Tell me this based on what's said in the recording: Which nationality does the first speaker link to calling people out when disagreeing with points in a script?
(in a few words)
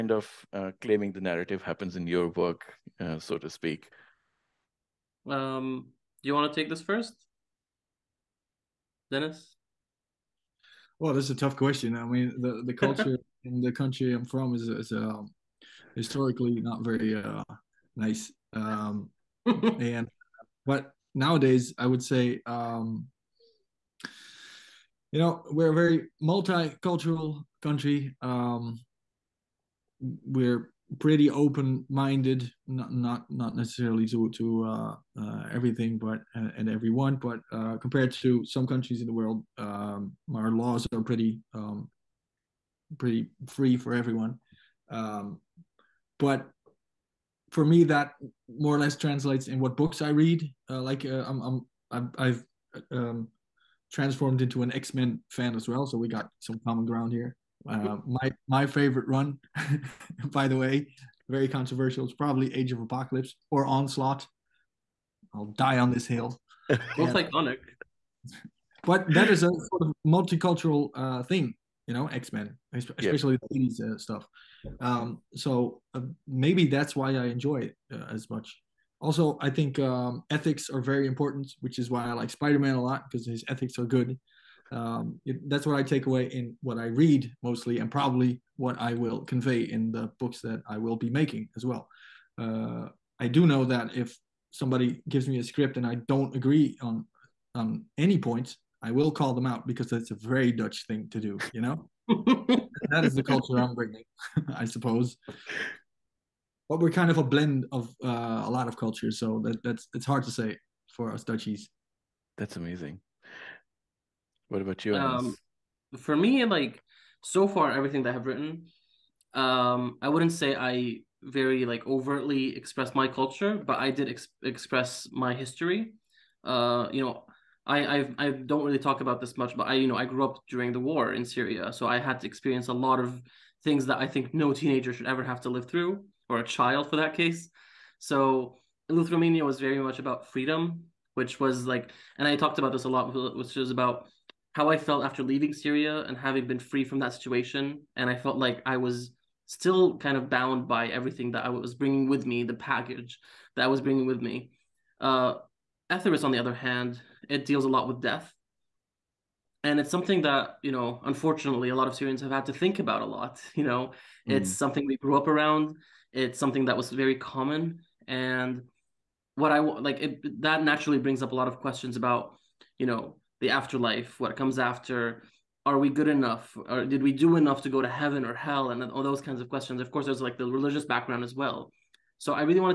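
Dutch.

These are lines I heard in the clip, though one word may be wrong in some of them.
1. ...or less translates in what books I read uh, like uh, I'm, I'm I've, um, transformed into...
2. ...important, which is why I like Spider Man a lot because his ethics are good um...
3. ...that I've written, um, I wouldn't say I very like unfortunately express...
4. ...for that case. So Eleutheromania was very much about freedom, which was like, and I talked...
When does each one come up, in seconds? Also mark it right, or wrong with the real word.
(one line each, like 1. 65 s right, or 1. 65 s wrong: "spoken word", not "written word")
1. 48 s right
2. 81 s right
3. 118 s wrong: "overtly", not "unfortunately"
4. 136 s right.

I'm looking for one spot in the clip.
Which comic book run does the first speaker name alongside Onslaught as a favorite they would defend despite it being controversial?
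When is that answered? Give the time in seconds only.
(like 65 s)
62 s.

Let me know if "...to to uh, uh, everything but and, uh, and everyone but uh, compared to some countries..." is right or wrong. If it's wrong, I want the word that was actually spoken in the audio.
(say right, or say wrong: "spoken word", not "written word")
right.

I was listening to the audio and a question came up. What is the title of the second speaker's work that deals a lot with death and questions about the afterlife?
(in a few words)
Etheres.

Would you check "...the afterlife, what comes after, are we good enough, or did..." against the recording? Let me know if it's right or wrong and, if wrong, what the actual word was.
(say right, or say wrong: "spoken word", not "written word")
right.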